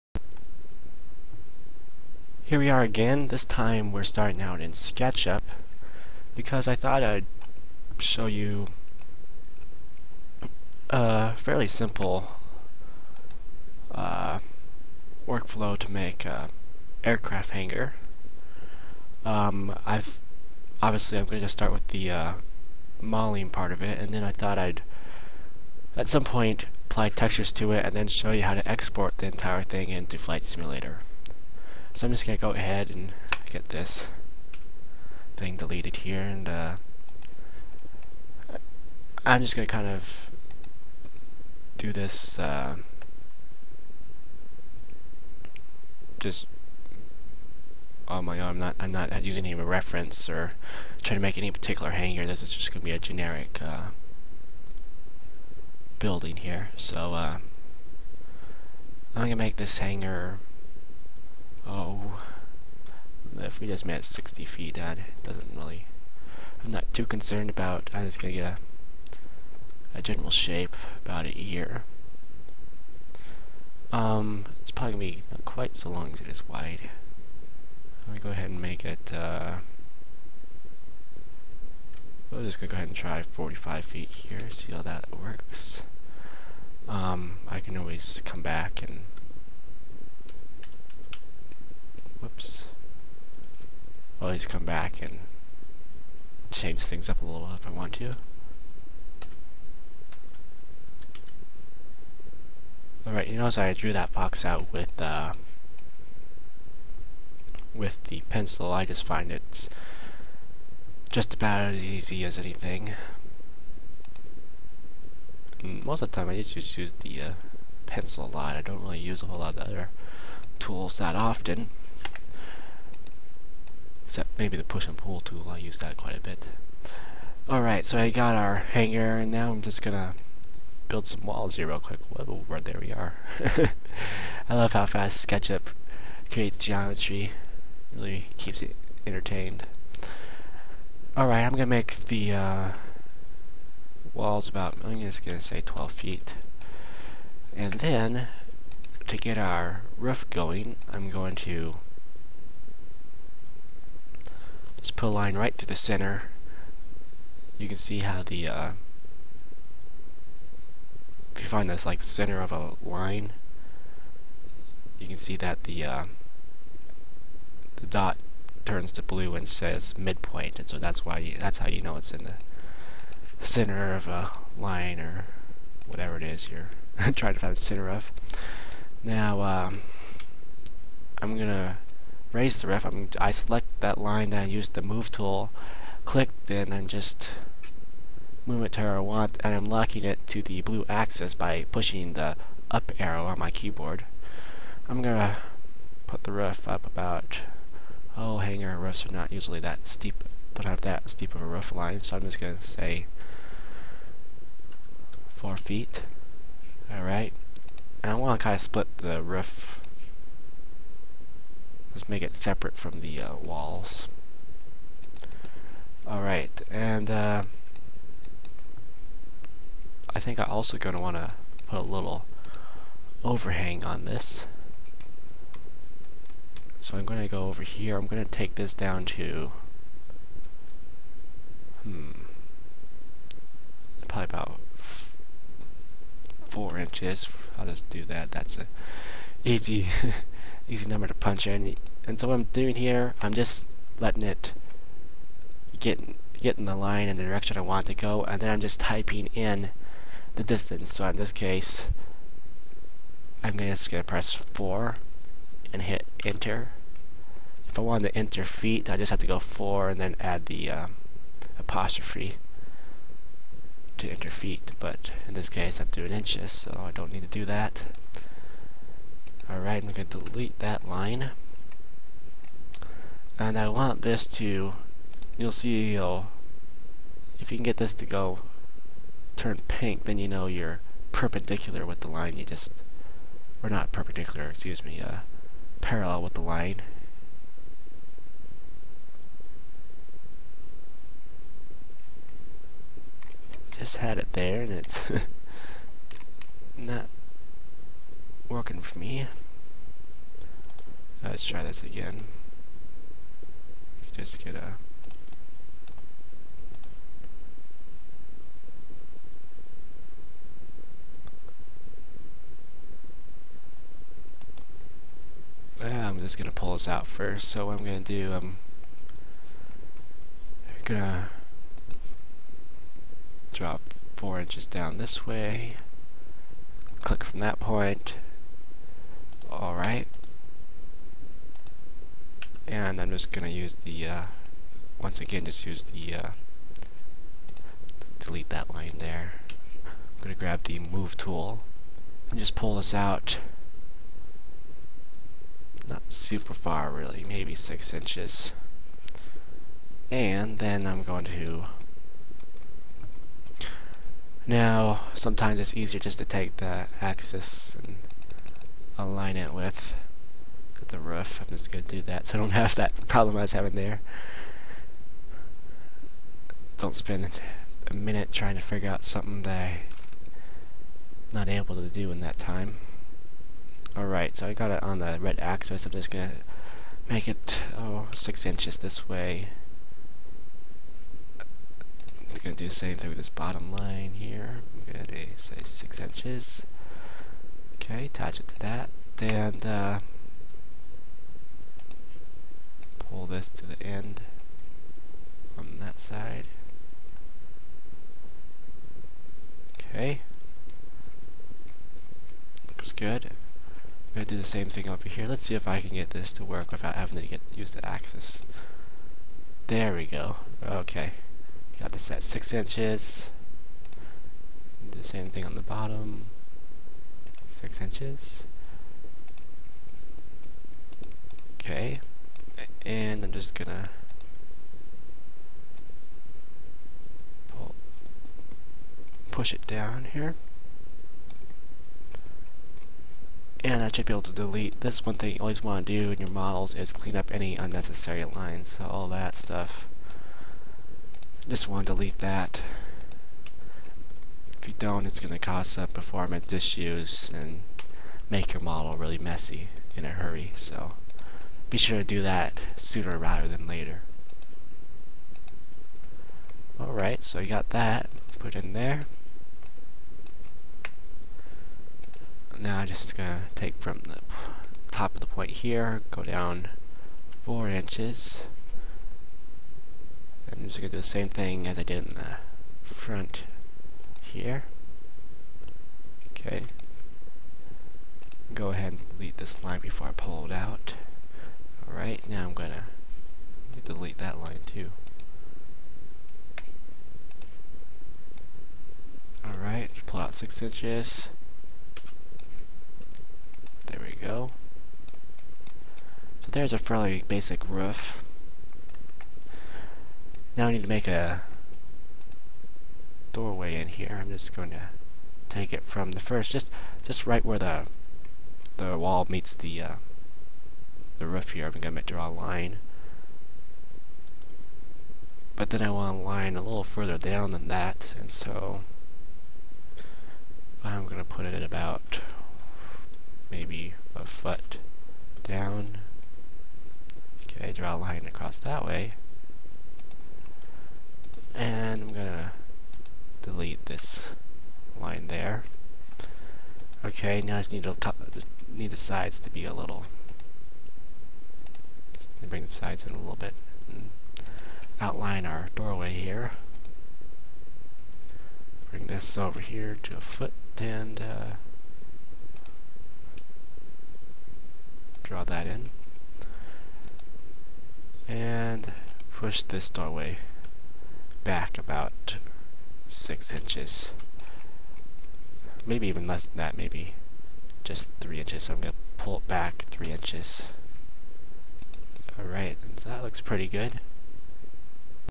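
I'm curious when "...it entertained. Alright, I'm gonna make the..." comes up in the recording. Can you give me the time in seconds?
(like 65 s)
138 s.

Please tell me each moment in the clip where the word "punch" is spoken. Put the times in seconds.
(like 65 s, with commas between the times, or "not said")
241 s.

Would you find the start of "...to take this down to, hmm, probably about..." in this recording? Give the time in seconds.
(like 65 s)
228 s.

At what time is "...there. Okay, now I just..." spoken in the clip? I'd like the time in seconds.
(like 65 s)
535 s.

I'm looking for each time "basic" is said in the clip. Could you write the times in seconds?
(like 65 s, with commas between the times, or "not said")
497 s.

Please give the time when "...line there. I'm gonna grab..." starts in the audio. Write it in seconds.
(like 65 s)
338 s.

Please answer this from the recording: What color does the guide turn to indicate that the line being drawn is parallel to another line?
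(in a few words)
pink.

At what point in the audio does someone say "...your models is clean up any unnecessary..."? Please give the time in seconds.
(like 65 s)
436 s.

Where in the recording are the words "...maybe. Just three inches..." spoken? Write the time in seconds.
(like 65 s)
566 s.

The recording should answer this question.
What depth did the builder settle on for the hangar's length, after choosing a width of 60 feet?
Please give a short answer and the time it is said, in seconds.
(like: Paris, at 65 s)
45 feet, at 83 s.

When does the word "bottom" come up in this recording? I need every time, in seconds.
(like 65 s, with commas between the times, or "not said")
383 s, 415 s.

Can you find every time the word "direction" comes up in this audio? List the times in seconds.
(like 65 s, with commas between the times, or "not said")
247 s.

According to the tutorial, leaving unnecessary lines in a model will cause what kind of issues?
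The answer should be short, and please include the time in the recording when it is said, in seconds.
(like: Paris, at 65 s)
performance issues, at 445 s.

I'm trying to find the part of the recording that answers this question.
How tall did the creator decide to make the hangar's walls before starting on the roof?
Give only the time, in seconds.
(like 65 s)
145 s.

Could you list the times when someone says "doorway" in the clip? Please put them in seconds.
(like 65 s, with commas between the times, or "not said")
503 s, 545 s, 559 s.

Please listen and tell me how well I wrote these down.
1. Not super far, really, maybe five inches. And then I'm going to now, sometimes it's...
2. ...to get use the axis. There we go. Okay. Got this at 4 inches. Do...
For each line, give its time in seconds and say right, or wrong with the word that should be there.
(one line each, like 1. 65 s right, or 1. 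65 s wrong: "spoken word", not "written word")
1. 345 s wrong: "six", not "five"
2. 407 s wrong: "6", not "4".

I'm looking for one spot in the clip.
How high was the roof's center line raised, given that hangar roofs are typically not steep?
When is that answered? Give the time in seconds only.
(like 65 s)
205 s.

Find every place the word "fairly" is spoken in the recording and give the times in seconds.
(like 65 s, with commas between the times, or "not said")
11 s, 496 s.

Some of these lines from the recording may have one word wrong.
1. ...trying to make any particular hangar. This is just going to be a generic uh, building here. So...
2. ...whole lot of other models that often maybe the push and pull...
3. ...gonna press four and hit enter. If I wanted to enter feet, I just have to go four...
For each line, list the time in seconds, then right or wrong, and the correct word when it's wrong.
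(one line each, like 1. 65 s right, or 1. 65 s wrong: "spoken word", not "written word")
1. 51 s right
2. 119 s wrong: "tools", not "models"
3. 253 s right.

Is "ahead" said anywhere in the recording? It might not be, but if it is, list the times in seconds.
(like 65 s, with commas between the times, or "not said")
32 s, 78 s, 82 s, 478 s.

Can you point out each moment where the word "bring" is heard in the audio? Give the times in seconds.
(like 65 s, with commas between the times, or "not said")
542 s, 548 s.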